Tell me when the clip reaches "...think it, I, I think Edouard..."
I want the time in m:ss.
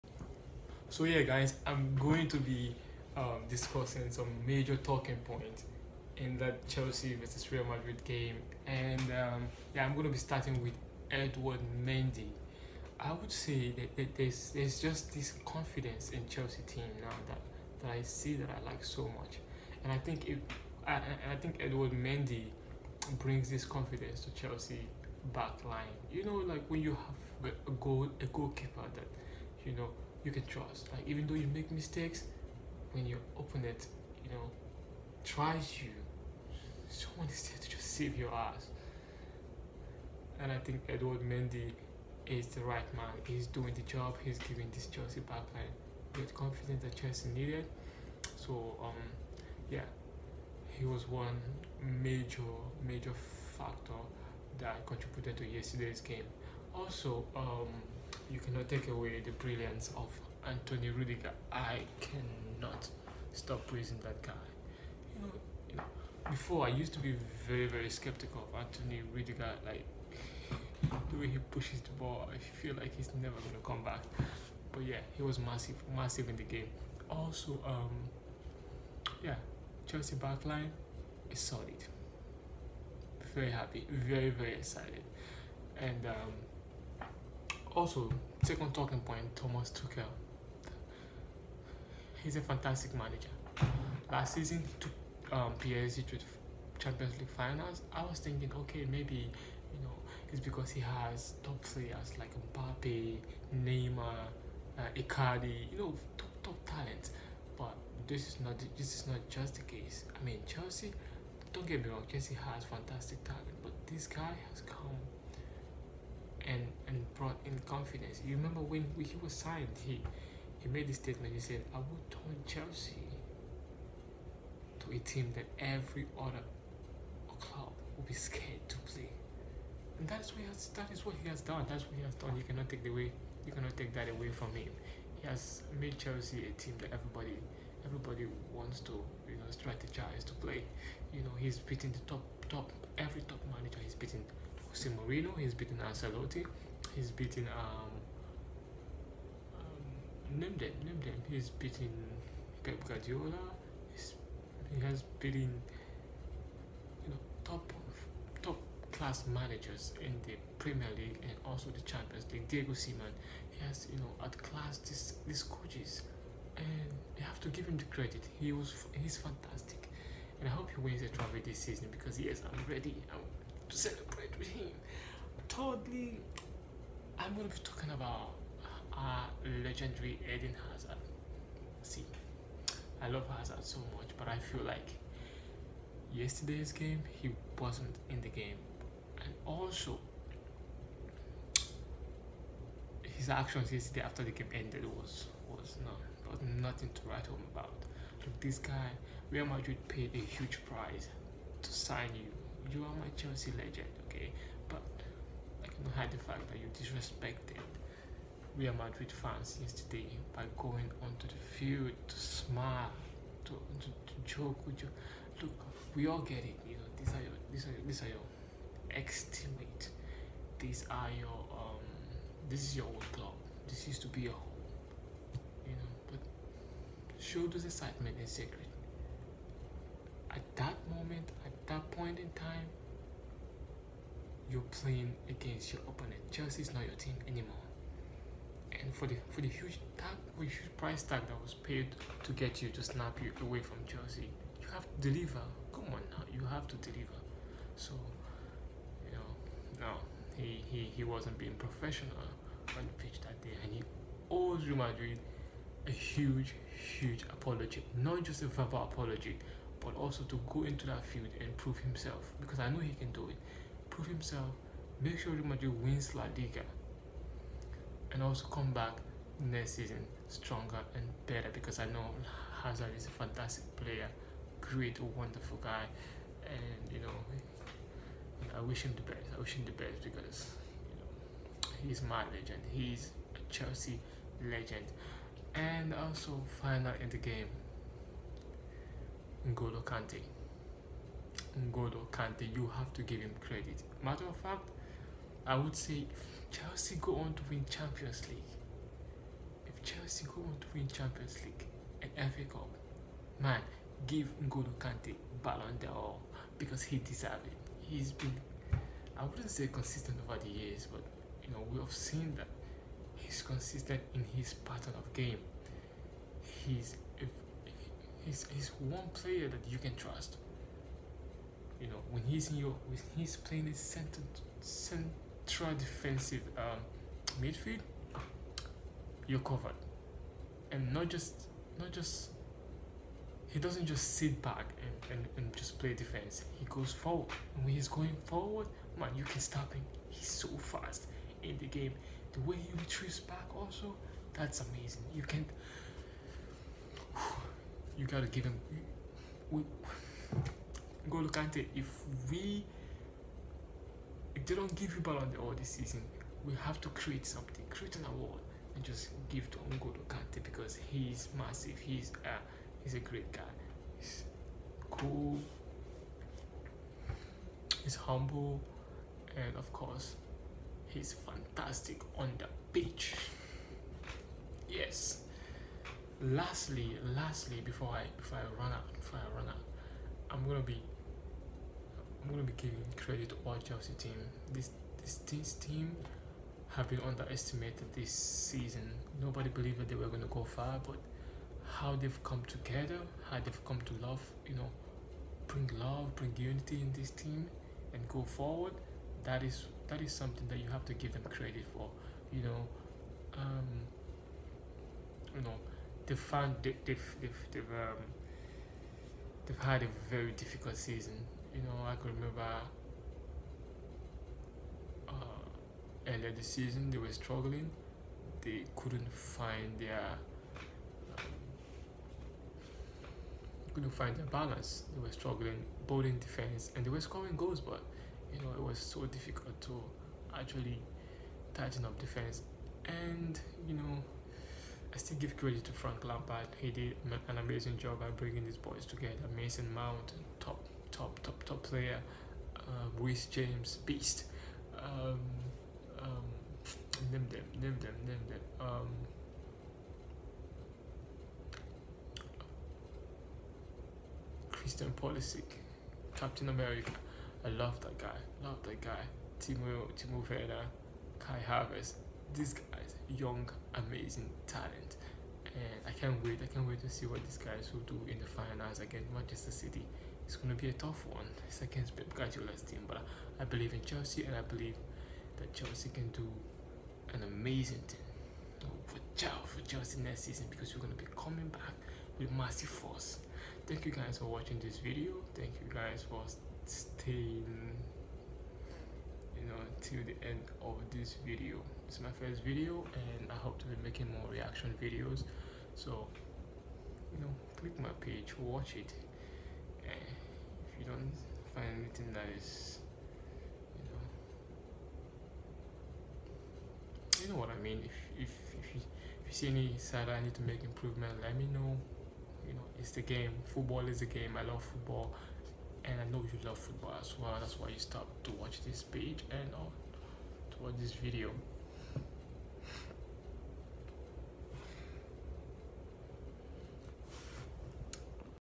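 0:19.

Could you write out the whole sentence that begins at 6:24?
This this this team have been underestimated this season.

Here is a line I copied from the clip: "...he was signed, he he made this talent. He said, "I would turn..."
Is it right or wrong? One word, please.
wrong.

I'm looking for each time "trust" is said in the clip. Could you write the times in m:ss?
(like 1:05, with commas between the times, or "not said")
0:30, 5:19.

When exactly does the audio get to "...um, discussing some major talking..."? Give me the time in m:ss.
0:03.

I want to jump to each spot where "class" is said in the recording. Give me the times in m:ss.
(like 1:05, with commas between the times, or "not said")
2:38, 2:44.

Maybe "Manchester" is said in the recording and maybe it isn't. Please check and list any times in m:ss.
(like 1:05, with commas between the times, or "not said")
7:49.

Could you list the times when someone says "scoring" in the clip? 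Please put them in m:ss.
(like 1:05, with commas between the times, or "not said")
7:07.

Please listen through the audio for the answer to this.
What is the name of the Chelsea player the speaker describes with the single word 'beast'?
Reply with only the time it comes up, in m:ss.
7:23.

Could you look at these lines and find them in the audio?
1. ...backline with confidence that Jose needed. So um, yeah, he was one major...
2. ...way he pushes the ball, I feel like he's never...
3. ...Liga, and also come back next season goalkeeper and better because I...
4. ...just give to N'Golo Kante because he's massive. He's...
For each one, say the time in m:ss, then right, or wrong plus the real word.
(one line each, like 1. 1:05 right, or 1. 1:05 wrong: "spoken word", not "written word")
1. 0:45 wrong: "Chelsea", not "Jose"
2. 1:11 right
3. 4:26 wrong: "stronger", not "goalkeeper"
4. 5:58 right.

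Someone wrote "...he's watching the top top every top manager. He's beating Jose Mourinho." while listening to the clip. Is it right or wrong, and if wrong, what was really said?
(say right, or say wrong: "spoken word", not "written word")
wrong: "beating", not "watching".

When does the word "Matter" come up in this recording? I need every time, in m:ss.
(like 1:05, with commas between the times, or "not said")
4:54.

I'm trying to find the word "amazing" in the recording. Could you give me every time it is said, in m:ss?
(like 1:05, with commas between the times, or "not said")
5:44, 7:17, 7:43, 7:57.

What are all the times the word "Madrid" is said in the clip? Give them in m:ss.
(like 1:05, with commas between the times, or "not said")
0:07, 3:19, 3:28, 4:14, 4:25.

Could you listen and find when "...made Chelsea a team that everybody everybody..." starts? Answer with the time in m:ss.
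2:15.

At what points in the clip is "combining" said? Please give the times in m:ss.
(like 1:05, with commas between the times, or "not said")
not said.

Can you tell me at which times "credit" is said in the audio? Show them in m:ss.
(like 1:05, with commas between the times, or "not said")
2:47, 4:53, 6:22, 6:41, 7:15.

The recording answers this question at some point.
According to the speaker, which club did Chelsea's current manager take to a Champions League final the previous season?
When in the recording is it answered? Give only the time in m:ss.
1:35.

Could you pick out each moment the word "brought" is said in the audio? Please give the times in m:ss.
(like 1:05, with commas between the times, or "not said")
1:57.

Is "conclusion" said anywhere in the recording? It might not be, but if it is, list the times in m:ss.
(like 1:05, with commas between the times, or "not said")
not said.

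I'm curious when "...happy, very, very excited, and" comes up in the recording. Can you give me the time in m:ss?
1:23.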